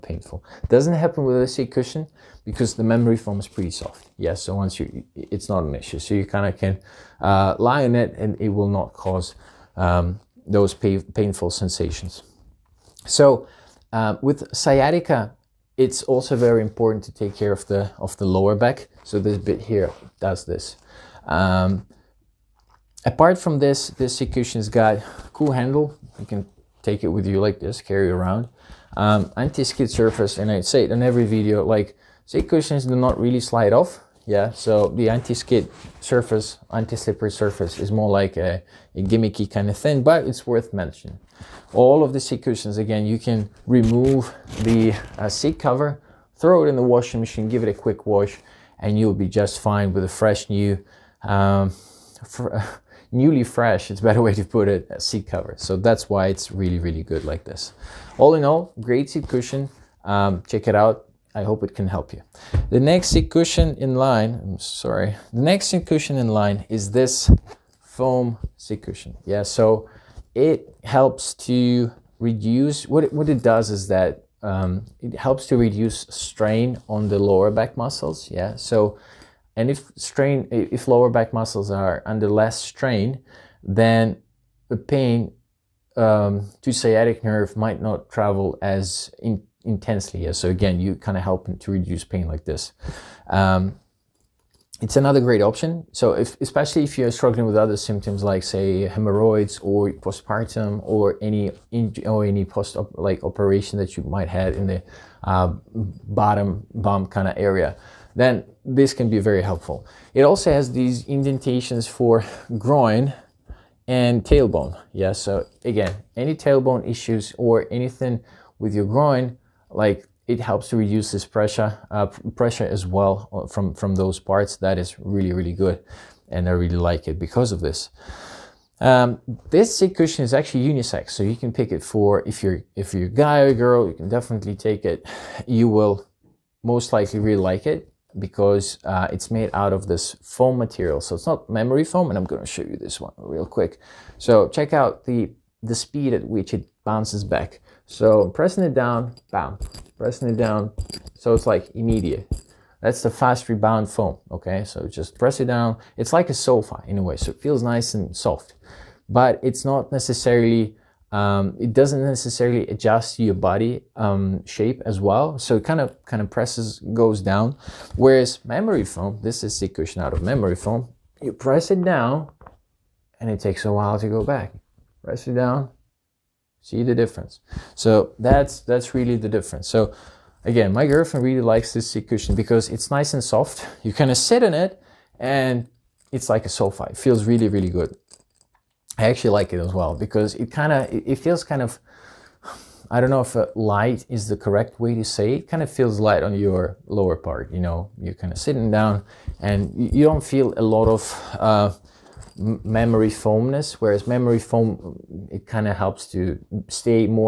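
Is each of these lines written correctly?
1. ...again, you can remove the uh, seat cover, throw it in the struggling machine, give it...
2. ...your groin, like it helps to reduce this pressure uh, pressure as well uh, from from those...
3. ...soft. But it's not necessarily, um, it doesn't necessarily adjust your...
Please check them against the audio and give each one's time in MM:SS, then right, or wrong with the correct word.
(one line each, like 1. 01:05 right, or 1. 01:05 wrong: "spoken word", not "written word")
1. 00:42 wrong: "washing", not "struggling"
2. 01:58 right
3. 02:38 right.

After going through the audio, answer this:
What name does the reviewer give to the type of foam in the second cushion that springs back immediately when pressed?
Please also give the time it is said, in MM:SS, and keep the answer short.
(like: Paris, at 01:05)
Fast rebound foam, at 02:33.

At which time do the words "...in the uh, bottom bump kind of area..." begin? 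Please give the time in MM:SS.
01:44.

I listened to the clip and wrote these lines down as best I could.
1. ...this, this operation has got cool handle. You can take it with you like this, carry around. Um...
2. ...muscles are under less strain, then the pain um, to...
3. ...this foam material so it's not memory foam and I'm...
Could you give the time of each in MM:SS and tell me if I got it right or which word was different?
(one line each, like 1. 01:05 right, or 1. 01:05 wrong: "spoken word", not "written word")
1. 00:23 wrong: "cushion", not "operation"
2. 01:21 right
3. 02:19 right.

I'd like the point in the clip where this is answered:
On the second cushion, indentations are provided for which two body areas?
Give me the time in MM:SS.
01:52.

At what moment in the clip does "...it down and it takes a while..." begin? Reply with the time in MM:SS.
02:51.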